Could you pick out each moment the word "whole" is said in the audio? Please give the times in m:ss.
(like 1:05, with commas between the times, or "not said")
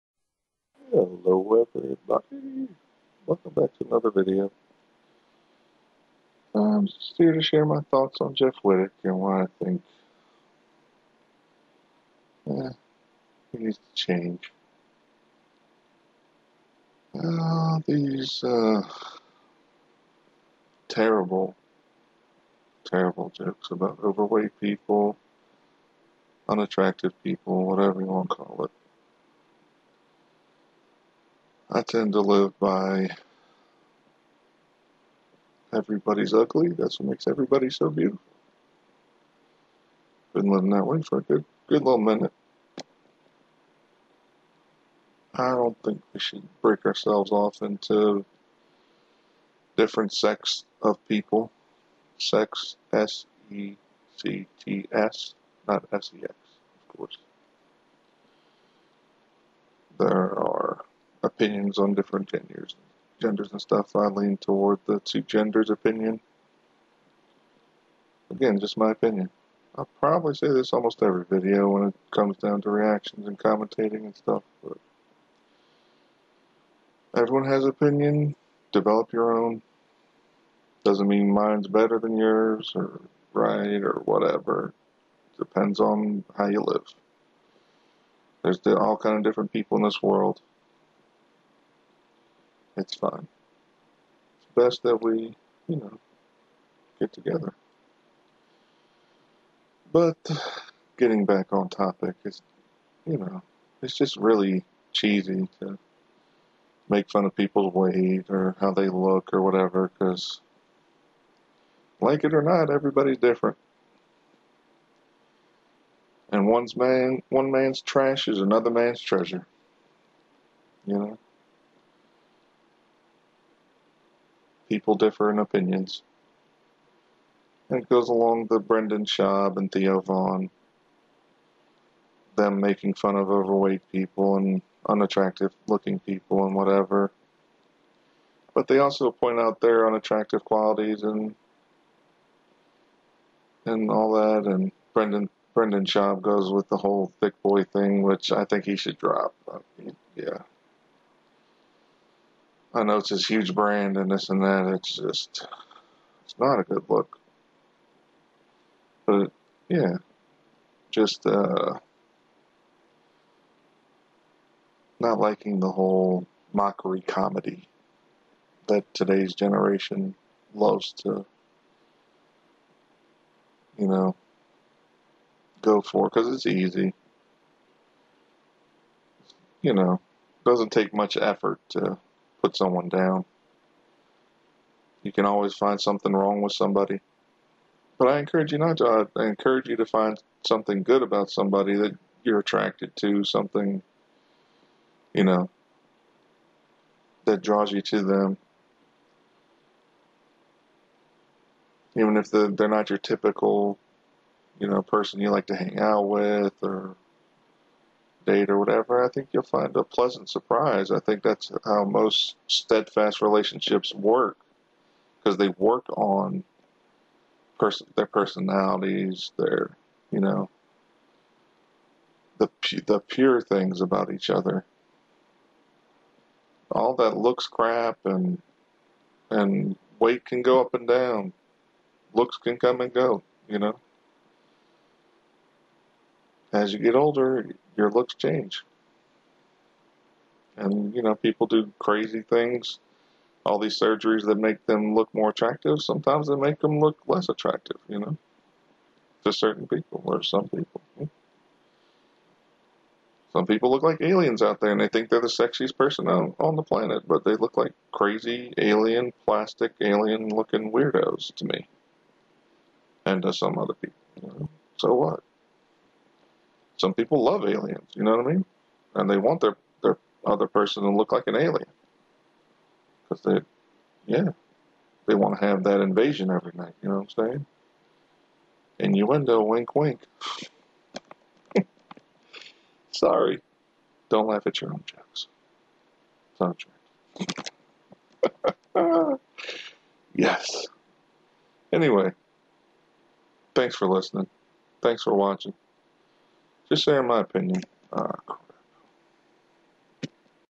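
2:26, 2:45.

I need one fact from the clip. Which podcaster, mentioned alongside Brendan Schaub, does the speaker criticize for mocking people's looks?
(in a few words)
Theo Von.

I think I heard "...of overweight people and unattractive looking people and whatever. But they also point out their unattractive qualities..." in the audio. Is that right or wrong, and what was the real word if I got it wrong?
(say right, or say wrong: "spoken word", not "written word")
right.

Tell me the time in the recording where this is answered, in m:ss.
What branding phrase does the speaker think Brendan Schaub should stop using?
2:27.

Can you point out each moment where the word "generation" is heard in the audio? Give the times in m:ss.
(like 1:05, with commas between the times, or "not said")
2:49.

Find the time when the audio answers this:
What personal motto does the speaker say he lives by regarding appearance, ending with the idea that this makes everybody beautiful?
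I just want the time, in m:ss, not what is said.
0:35.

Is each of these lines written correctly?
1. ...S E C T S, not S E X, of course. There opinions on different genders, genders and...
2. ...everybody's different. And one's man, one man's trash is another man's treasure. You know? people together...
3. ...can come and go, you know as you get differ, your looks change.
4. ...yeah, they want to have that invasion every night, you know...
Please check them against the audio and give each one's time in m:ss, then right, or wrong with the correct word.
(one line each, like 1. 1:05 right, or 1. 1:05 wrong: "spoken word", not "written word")
1. 0:52 right
2. 1:52 wrong: "differ", not "together"
3. 3:52 wrong: "older", not "differ"
4. 4:34 right.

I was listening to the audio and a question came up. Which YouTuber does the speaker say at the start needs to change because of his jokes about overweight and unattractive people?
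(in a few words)
Jeff Wittek.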